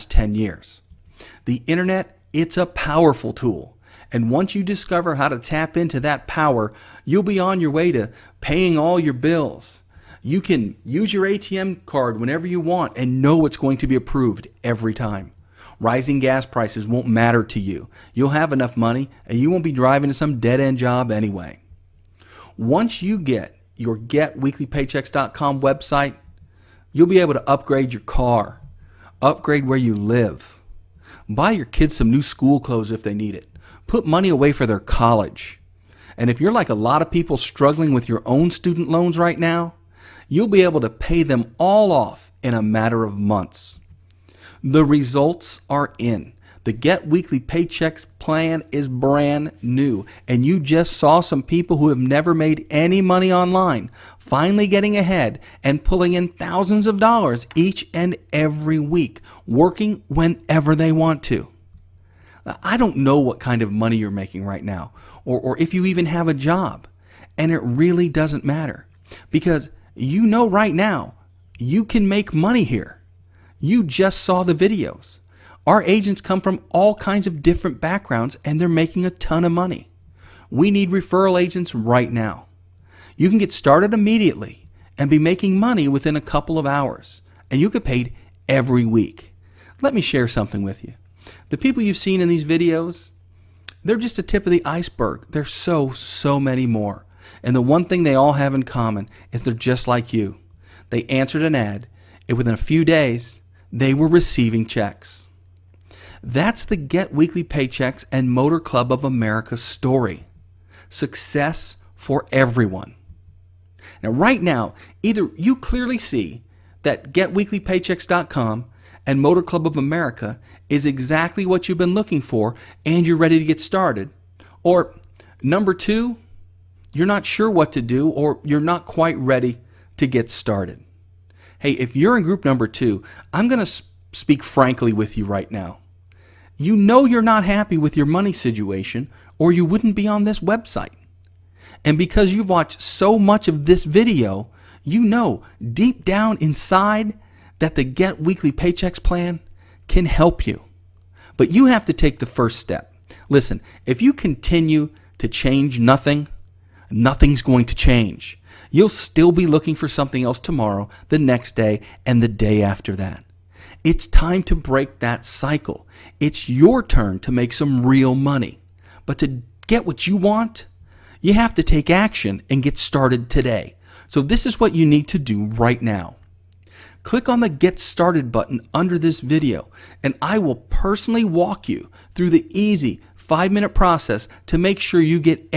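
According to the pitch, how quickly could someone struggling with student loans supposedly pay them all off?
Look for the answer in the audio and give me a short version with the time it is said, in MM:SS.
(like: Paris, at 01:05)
in a matter of months, at 00:42.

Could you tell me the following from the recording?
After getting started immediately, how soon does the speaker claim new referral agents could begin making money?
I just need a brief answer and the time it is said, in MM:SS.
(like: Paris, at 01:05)
within a couple of hours, at 01:25.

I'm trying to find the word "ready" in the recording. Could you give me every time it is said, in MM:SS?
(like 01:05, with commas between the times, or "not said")
02:03, 02:09.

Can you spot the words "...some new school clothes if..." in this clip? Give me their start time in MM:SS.
00:31.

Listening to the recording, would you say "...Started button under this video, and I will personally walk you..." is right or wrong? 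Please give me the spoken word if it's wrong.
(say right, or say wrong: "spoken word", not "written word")
right.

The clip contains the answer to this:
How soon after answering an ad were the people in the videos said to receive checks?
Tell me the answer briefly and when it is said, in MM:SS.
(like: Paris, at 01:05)
within a few days, at 01:42.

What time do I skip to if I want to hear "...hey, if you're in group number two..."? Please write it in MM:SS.
02:11.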